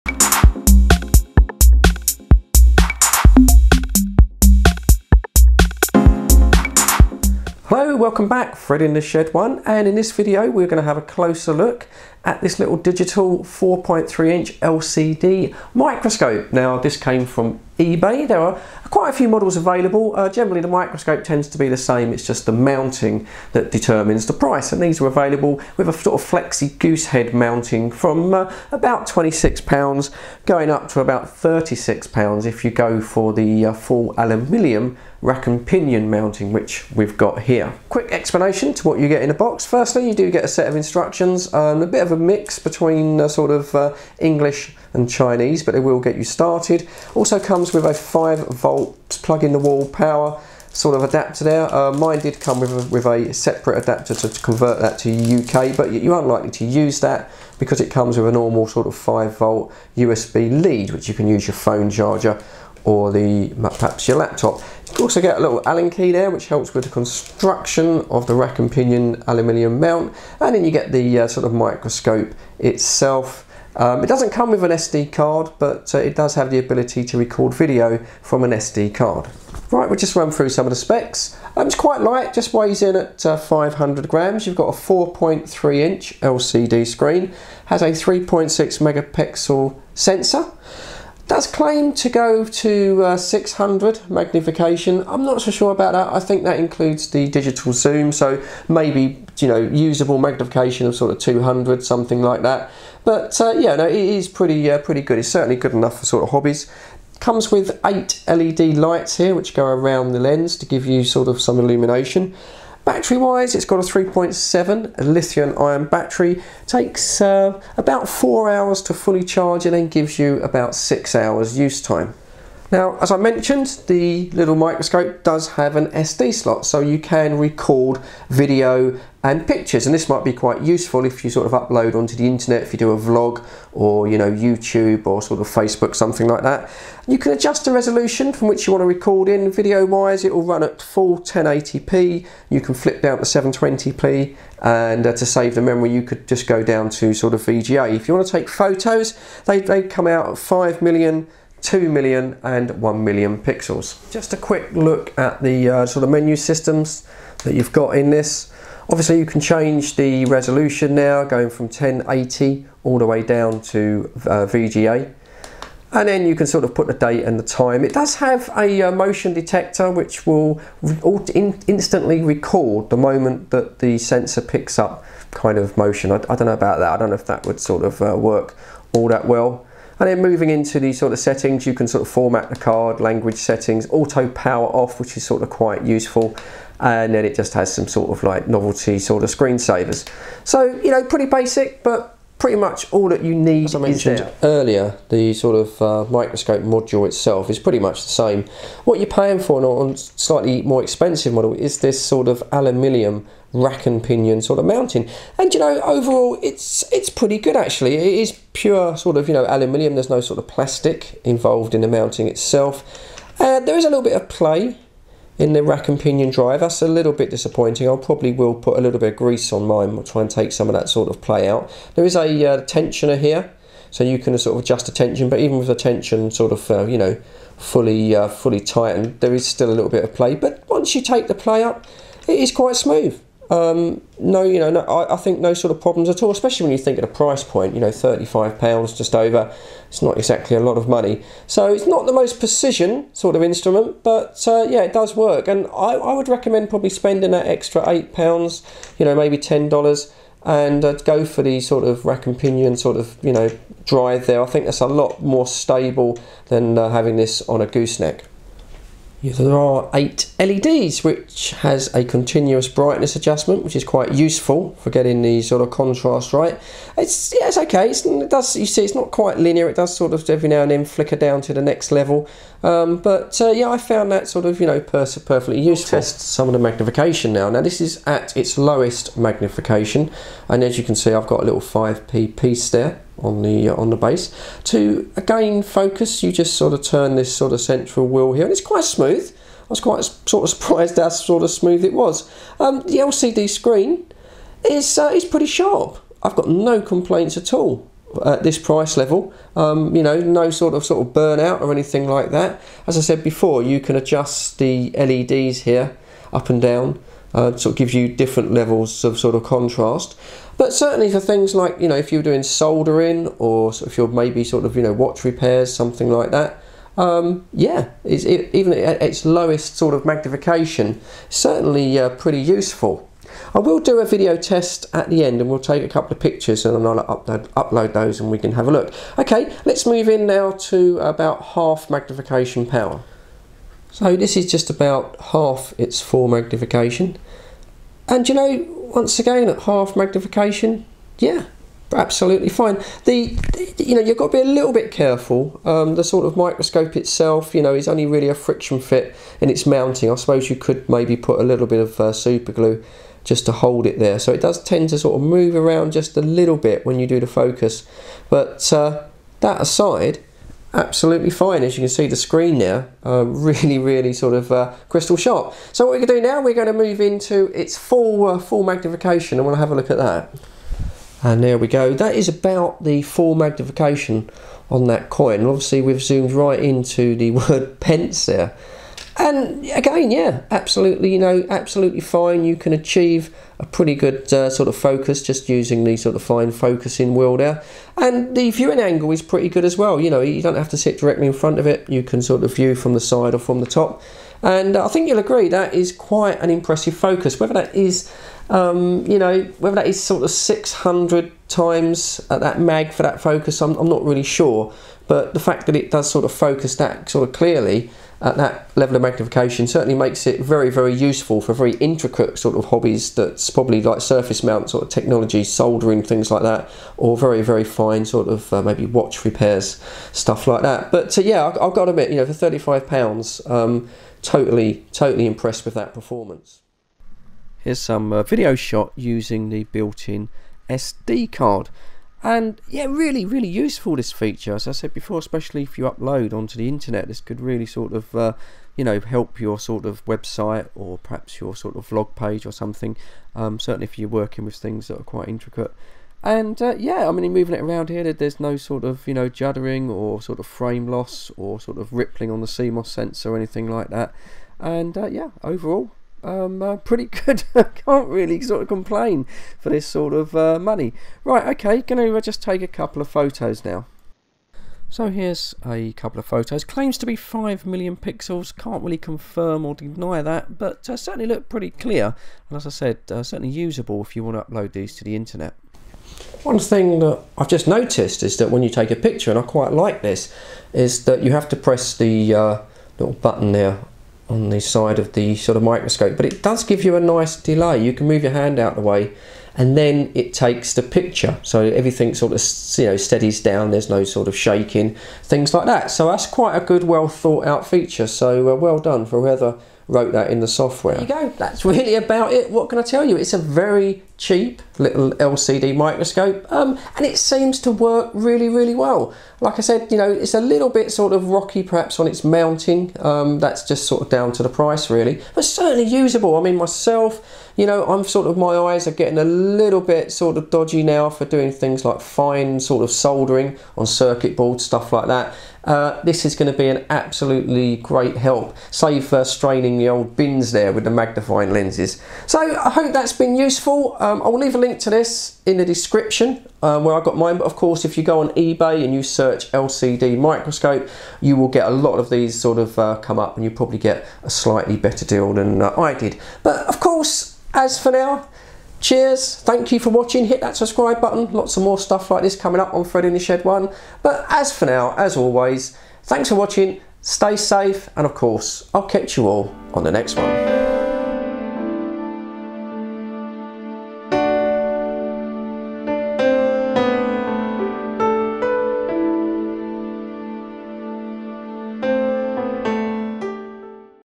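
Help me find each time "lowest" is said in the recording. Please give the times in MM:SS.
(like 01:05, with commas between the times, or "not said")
04:38, 05:19.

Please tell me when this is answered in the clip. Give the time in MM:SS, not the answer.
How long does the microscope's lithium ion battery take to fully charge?
01:57.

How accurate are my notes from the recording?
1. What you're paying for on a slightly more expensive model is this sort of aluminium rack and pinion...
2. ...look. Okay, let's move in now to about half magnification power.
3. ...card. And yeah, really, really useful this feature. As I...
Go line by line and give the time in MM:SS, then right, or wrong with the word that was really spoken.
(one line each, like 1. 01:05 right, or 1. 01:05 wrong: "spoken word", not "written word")
1. 03:18 right
2. 05:28 right
3. 07:11 right.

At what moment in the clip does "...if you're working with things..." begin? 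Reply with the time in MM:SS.
07:23.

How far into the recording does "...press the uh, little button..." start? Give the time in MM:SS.
08:01.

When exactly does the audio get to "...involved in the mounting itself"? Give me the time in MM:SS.
03:31.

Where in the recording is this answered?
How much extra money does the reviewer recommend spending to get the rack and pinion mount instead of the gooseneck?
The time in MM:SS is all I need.
04:07.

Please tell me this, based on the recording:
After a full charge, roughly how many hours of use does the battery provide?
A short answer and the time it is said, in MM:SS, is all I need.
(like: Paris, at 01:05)
6 hours, at 02:00.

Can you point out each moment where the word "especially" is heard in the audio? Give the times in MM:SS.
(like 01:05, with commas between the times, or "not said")
03:56, 07:15.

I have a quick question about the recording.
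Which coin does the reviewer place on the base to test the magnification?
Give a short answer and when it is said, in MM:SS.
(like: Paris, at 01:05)
5p piece, at 04:41.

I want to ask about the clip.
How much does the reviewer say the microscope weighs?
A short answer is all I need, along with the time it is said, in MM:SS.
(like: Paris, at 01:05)
500 grams, at 01:23.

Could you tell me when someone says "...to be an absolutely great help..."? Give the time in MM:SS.
08:46.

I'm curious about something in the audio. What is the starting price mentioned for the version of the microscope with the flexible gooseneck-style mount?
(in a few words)
£26.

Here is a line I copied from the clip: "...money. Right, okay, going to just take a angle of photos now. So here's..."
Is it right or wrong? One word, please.
wrong.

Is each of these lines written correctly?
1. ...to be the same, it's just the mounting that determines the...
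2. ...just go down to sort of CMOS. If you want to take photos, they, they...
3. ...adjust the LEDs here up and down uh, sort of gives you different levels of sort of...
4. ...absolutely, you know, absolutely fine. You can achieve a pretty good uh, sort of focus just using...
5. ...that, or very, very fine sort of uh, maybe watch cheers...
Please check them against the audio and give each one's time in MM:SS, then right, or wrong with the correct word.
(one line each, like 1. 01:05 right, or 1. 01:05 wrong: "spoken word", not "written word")
1. 00:21 right
2. 02:26 wrong: "VGA", not "CMOS"
3. 05:03 right
4. 06:20 right
5. 06:56 wrong: "repairs", not "cheers".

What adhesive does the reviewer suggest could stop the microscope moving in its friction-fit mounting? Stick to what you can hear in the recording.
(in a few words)
super glue.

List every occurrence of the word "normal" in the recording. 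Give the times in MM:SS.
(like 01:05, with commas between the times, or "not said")
00:58.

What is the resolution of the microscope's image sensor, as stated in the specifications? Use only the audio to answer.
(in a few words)
3.6 megapixels.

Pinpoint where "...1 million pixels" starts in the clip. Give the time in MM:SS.
02:32.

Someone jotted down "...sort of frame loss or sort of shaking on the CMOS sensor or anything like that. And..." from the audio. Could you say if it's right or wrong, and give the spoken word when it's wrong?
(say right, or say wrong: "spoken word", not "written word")
wrong: "rippling", not "shaking".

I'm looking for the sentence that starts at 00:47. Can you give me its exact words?
Also comes with a 5 volt plug in the wall power sort of adapter there.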